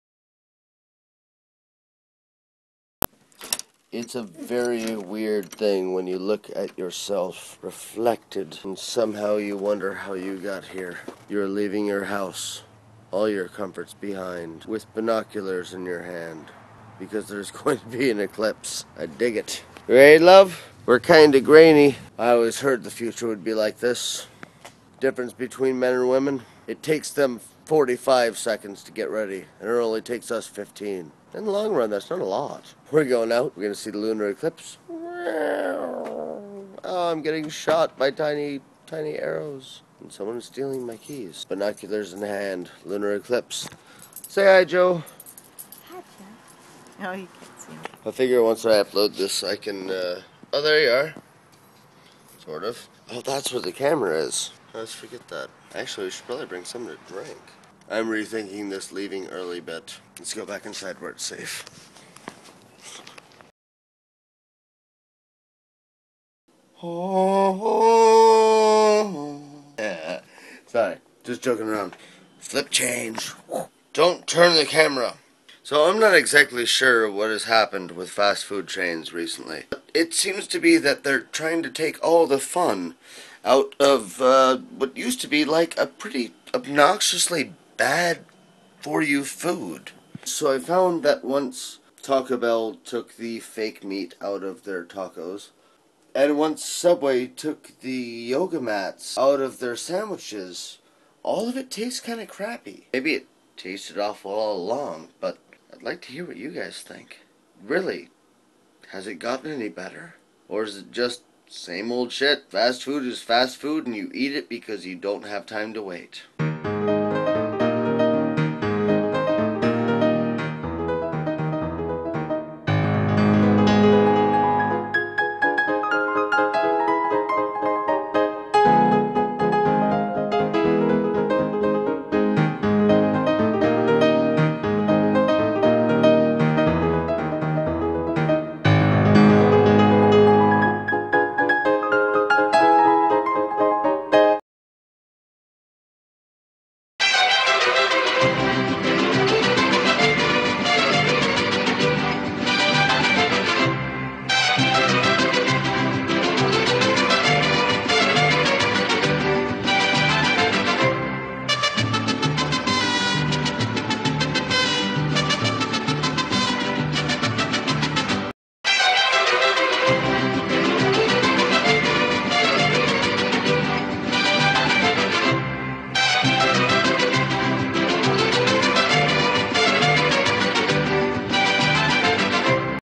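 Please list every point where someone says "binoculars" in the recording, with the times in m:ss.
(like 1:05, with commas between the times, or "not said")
0:14, 0:41.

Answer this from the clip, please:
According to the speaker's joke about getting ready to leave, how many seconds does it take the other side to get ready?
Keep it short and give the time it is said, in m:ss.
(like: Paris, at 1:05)
45 seconds, at 0:27.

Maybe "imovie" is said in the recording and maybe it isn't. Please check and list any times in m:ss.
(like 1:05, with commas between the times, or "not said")
not said.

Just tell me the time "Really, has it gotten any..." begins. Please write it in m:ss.
1:47.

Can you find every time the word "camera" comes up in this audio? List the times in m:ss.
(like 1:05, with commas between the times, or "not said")
0:53, 1:14.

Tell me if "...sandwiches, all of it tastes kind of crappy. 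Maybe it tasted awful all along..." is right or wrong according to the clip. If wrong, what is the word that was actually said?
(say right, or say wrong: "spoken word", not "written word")
right.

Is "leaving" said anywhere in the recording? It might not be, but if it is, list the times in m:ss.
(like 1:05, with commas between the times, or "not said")
0:11, 0:58.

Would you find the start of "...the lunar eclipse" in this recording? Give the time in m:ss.
0:33.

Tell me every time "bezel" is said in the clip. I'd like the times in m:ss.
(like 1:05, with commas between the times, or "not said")
not said.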